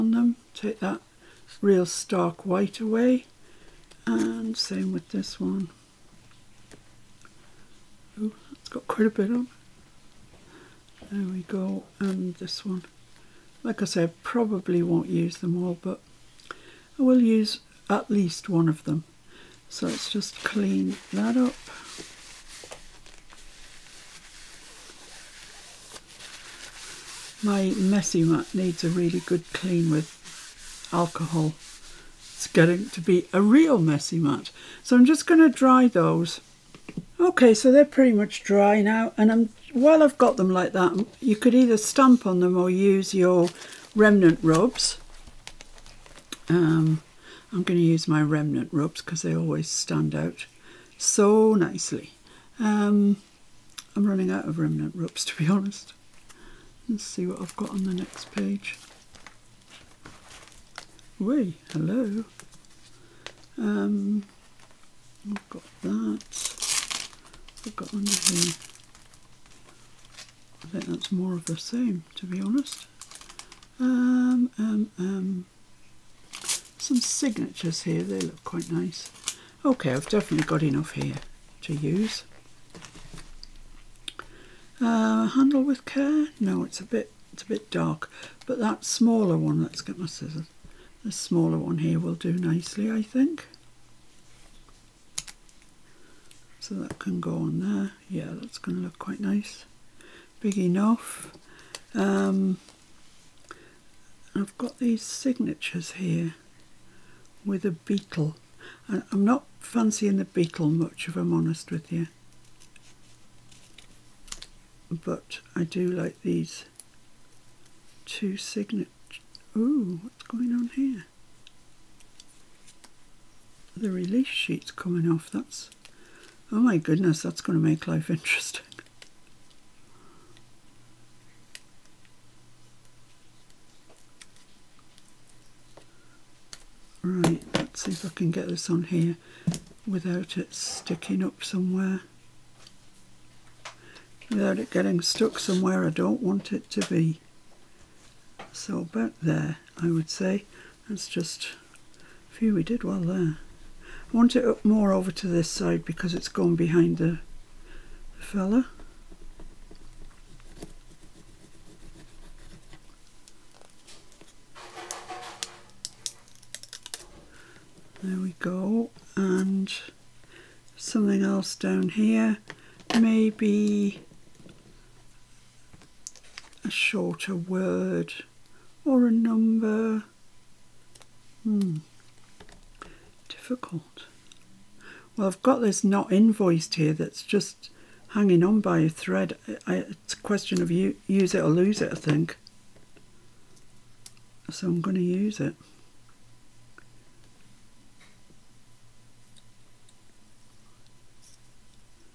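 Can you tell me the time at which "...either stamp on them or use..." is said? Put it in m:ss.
0:41.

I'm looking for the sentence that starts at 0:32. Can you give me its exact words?
It's getting to be a real messy mat.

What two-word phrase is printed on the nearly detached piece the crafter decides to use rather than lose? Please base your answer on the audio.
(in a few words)
not invoiced.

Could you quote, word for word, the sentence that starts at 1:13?
Um, um, um, some signatures here.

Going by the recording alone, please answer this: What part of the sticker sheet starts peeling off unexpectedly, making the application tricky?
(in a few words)
release sheet.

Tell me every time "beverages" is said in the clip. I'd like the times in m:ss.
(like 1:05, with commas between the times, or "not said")
not said.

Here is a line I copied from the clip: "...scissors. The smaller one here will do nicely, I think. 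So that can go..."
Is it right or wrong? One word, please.
right.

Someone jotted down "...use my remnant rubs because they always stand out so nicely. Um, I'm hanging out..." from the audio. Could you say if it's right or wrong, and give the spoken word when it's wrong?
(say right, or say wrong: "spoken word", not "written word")
wrong: "running", not "hanging".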